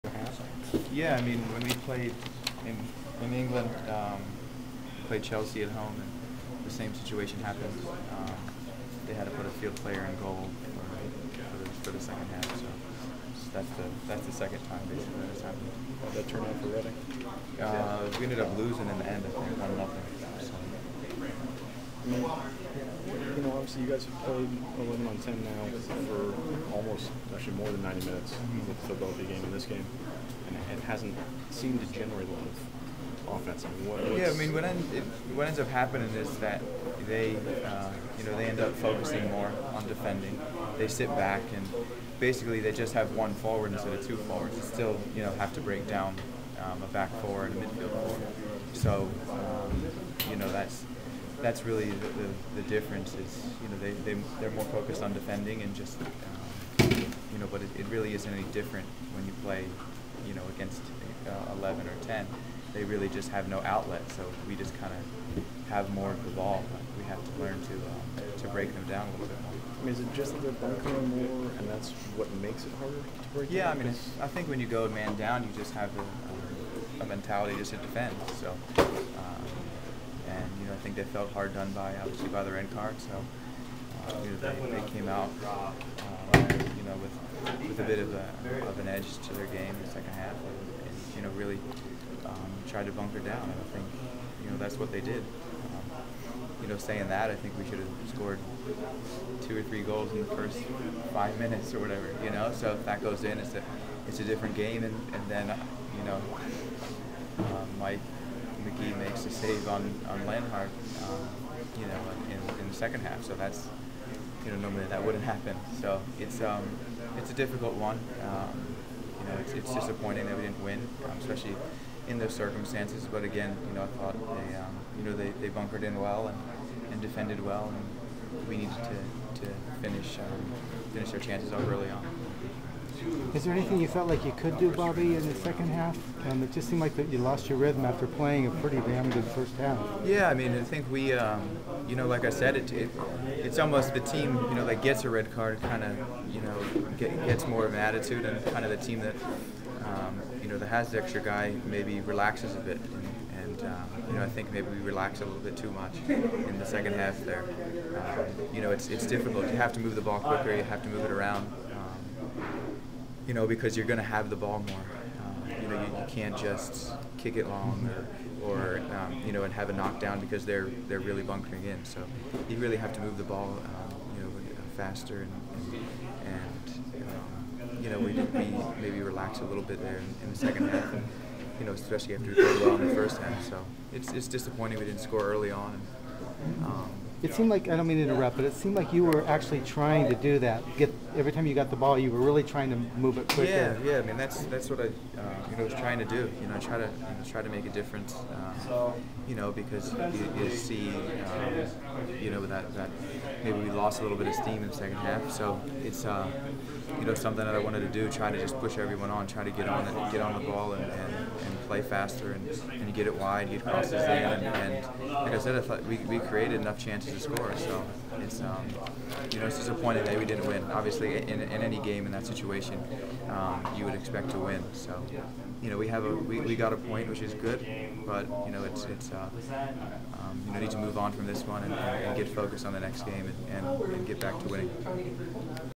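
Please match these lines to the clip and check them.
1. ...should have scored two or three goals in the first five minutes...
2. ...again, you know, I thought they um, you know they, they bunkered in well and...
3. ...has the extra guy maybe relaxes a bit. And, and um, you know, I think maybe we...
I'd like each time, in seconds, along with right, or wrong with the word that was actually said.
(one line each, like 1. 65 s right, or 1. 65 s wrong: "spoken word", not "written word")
1. 97 s right
2. 123 s right
3. 150 s right.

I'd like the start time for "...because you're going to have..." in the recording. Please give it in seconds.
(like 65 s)
163 s.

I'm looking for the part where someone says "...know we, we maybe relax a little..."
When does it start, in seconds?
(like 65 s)
177 s.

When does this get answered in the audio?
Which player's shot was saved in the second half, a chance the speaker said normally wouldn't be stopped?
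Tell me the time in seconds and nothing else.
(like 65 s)
110 s.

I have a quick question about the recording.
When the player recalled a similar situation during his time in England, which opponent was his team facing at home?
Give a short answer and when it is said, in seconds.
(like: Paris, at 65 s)
Chelsea, at 5 s.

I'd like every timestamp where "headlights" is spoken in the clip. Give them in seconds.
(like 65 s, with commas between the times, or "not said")
not said.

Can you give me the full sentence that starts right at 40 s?
They sit back and basically they just have one forward instead of two forwards.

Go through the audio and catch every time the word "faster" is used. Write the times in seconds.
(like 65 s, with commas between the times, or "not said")
174 s, 211 s.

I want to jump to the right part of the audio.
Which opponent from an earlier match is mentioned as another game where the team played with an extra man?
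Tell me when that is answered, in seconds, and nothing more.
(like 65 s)
28 s.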